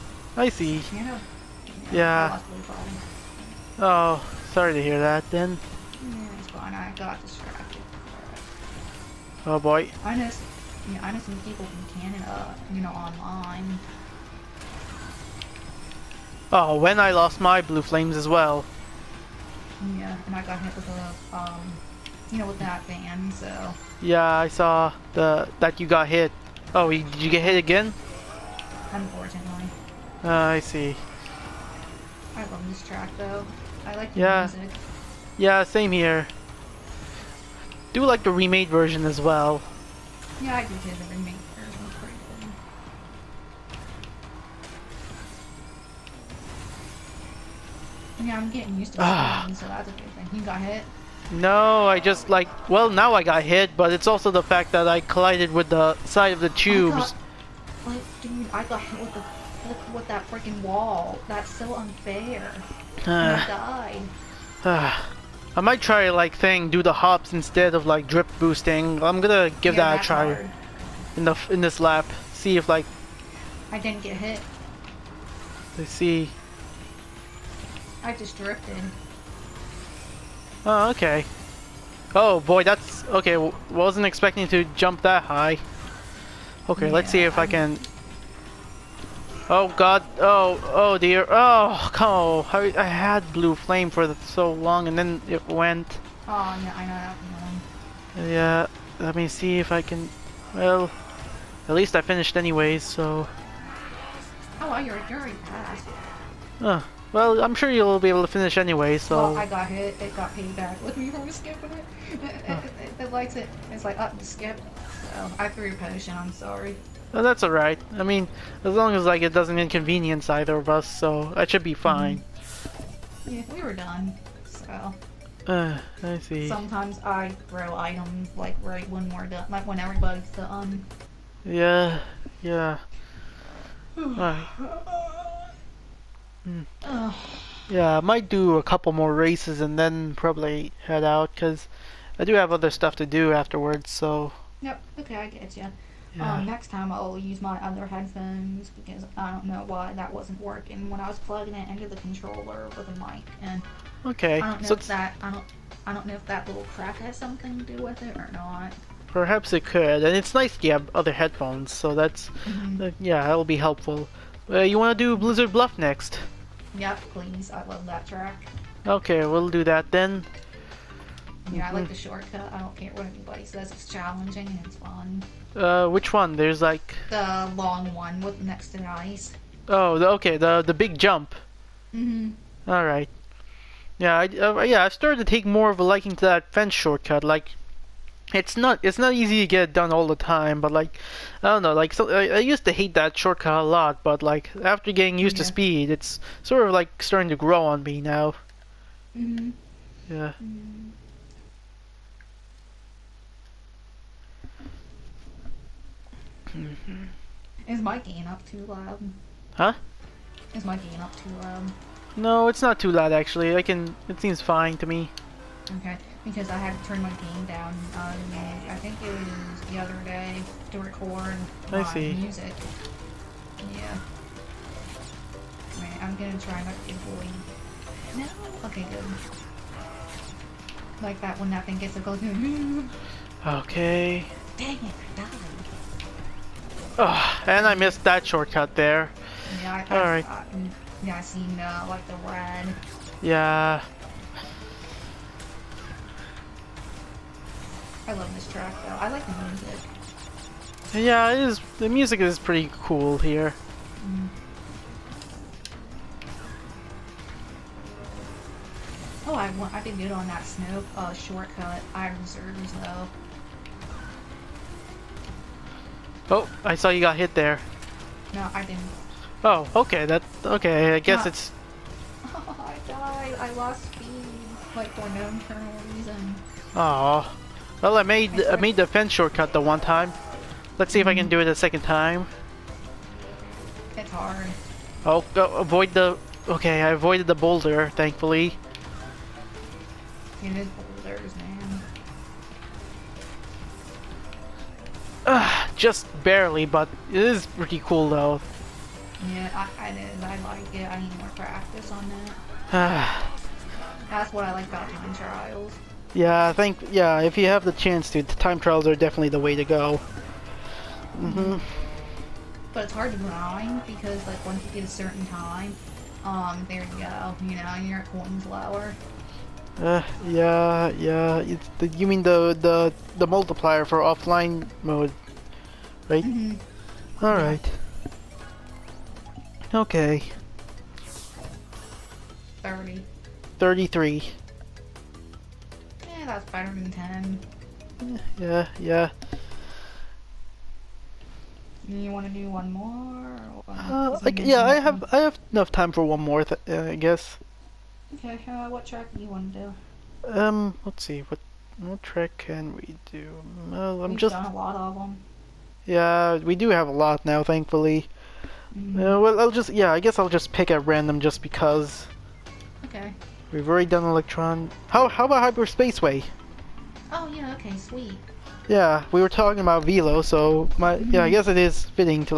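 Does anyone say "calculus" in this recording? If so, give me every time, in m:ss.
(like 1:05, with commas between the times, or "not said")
not said.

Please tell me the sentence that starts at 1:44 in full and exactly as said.
Oh, well, you're, you're already past.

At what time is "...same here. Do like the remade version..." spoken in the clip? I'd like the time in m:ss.
0:35.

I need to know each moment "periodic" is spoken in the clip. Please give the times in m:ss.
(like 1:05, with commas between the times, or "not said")
not said.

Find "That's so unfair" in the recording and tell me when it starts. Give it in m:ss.
1:01.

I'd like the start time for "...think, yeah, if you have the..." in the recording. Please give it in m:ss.
5:06.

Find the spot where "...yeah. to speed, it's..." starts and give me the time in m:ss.
3:15.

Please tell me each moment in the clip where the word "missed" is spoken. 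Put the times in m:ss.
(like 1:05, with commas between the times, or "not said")
3:57.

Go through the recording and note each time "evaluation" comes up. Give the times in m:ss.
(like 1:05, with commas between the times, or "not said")
not said.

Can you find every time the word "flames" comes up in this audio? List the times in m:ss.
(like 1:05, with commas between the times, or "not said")
0:17, 1:33.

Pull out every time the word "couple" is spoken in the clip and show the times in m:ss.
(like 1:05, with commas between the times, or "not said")
2:18.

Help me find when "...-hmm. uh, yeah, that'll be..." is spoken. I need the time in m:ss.
2:42.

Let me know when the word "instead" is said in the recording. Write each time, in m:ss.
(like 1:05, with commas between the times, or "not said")
1:07.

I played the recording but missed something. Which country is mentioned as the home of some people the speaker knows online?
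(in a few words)
Canada.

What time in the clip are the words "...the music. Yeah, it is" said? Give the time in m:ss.
4:09.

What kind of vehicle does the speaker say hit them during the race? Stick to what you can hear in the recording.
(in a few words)
van.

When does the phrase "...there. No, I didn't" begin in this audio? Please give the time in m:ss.
4:27.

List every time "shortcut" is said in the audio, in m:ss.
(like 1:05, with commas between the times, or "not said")
2:51, 3:06, 3:13, 3:58, 4:21, 4:39.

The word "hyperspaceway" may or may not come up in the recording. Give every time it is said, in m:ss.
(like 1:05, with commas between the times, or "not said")
6:05.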